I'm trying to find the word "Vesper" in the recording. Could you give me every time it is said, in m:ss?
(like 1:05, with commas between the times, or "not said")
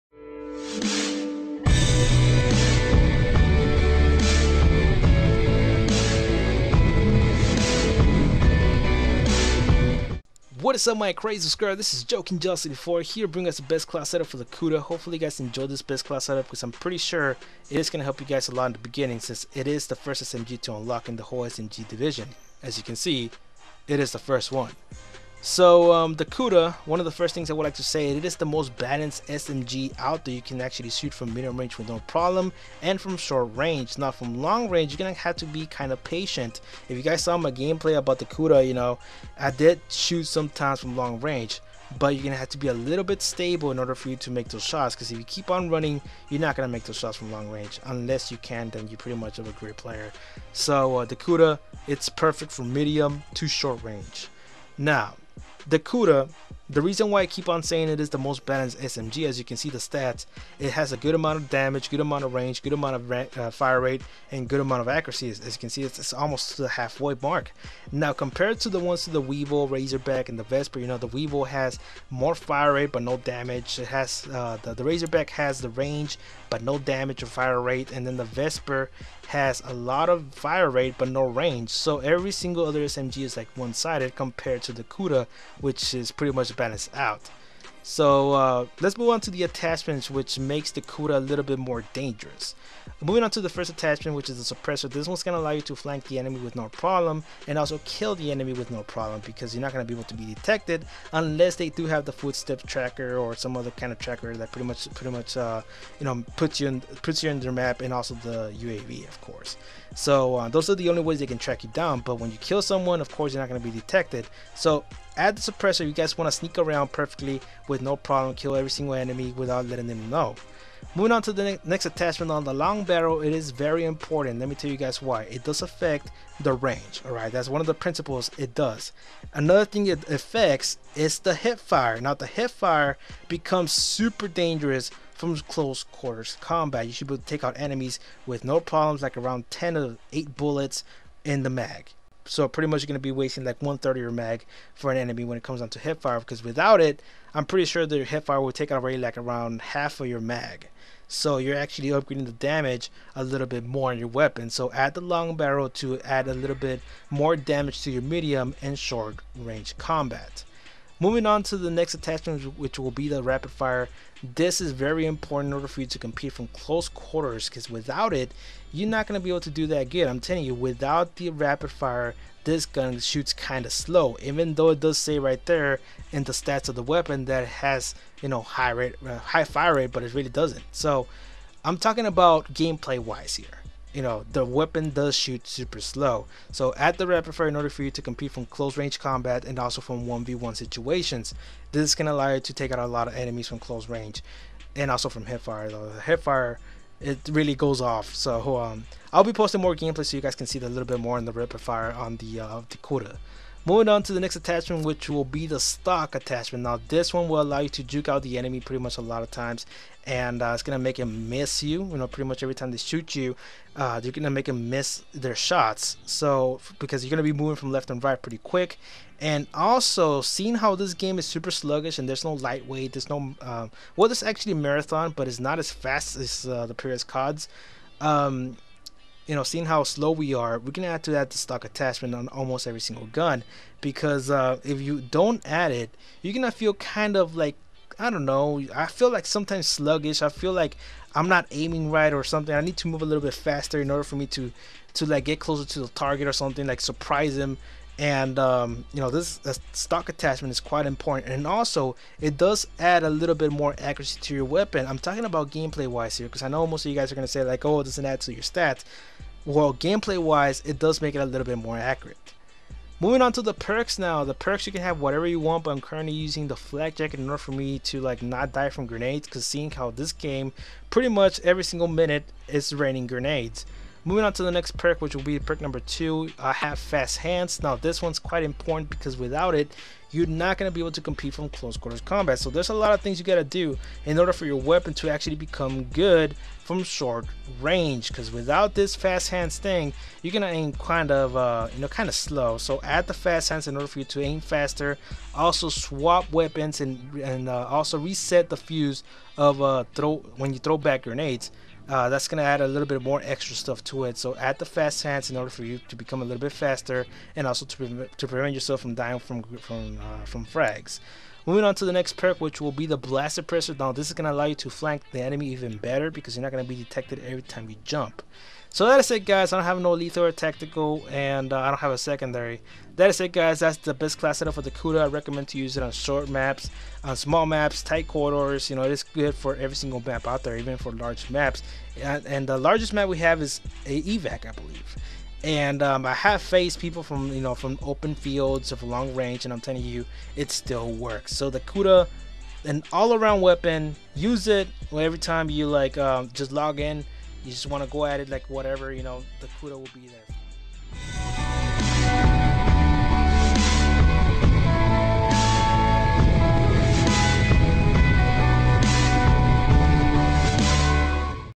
1:10, 1:18.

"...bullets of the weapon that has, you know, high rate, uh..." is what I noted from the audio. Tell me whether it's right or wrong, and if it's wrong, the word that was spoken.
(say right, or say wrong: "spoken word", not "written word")
wrong: "stats", not "bullets".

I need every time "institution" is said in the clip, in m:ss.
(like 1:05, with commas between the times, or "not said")
not said.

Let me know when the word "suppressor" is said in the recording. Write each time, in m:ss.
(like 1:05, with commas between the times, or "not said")
1:34, 1:55, 5:13.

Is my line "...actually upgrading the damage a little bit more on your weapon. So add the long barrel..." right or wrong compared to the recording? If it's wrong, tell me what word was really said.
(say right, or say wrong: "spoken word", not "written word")
right.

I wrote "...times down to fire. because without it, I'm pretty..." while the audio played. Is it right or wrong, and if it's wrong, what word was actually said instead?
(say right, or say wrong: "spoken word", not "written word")
wrong: "comes", not "times".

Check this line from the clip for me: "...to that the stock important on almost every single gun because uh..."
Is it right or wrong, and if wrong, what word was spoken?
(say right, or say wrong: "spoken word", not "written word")
wrong: "attachment", not "important".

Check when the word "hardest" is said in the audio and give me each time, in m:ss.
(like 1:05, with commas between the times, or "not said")
not said.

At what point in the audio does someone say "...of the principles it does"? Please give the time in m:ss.
2:07.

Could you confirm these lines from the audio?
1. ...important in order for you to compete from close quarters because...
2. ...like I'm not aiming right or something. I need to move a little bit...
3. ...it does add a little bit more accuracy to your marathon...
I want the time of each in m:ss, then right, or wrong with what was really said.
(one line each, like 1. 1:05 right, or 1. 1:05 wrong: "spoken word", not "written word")
1. 2:45 right
2. 4:00 right
3. 4:12 wrong: "weapon", not "marathon".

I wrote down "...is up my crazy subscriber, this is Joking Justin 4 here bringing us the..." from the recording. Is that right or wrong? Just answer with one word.
right.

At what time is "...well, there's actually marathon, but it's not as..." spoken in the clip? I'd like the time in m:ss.
3:43.